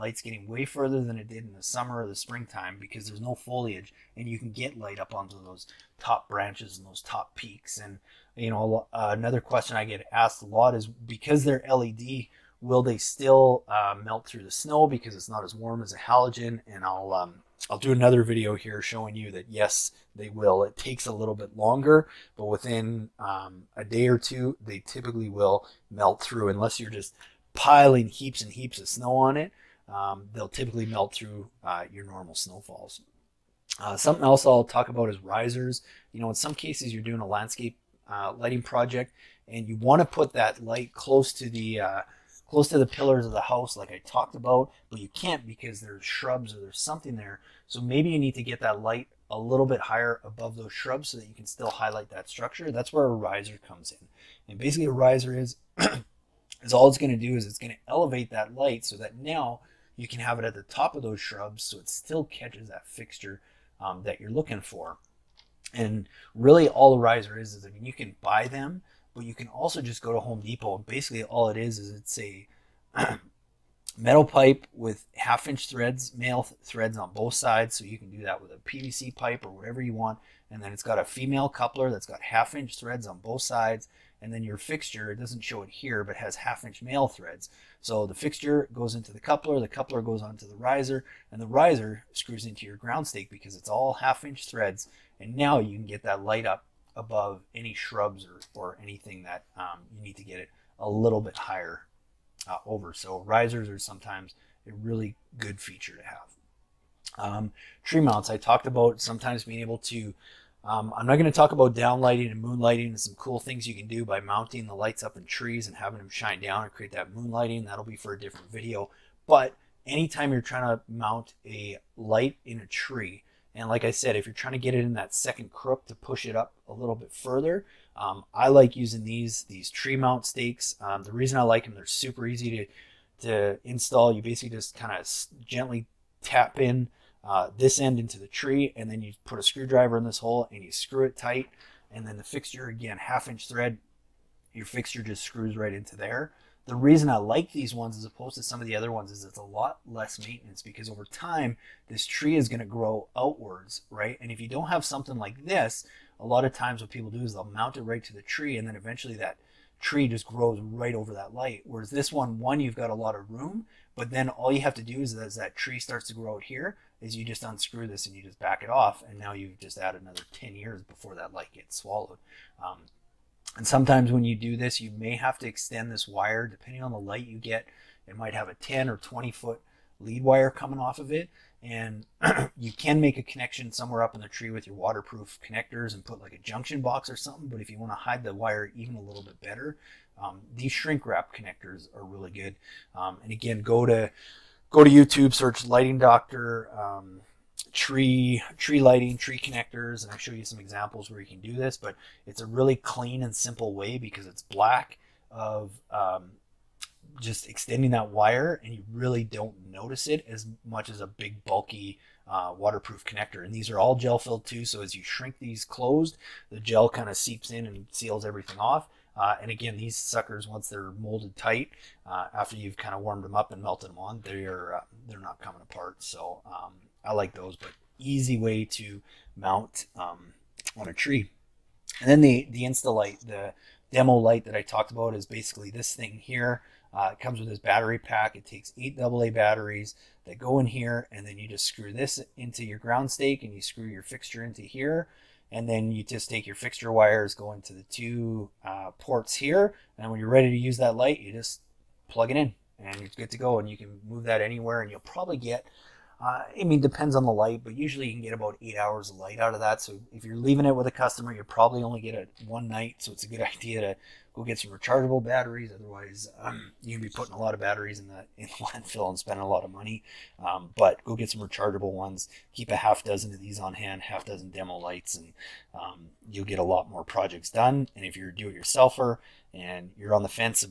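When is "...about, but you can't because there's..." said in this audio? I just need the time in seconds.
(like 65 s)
44 s.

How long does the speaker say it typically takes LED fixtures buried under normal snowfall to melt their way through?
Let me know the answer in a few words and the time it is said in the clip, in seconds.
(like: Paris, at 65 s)
a day or two, at 23 s.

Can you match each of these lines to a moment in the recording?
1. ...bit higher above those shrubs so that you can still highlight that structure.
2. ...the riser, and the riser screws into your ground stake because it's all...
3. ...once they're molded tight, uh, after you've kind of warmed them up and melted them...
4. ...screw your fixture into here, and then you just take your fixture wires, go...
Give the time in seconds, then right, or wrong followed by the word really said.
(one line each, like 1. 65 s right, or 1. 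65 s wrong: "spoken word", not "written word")
1. 49 s right
2. 90 s right
3. 220 s right
4. 243 s right.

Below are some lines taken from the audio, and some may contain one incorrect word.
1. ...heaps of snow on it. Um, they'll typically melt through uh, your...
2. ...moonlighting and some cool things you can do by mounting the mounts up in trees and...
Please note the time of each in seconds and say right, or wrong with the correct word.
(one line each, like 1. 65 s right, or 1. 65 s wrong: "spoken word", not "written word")
1. 28 s right
2. 112 s wrong: "lights", not "mounts".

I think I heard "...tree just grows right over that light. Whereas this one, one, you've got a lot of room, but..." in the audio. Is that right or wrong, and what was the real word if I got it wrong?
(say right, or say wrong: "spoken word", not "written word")
right.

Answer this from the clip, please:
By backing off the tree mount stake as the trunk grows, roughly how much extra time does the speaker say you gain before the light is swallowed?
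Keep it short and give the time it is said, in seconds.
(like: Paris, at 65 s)
10 years, at 170 s.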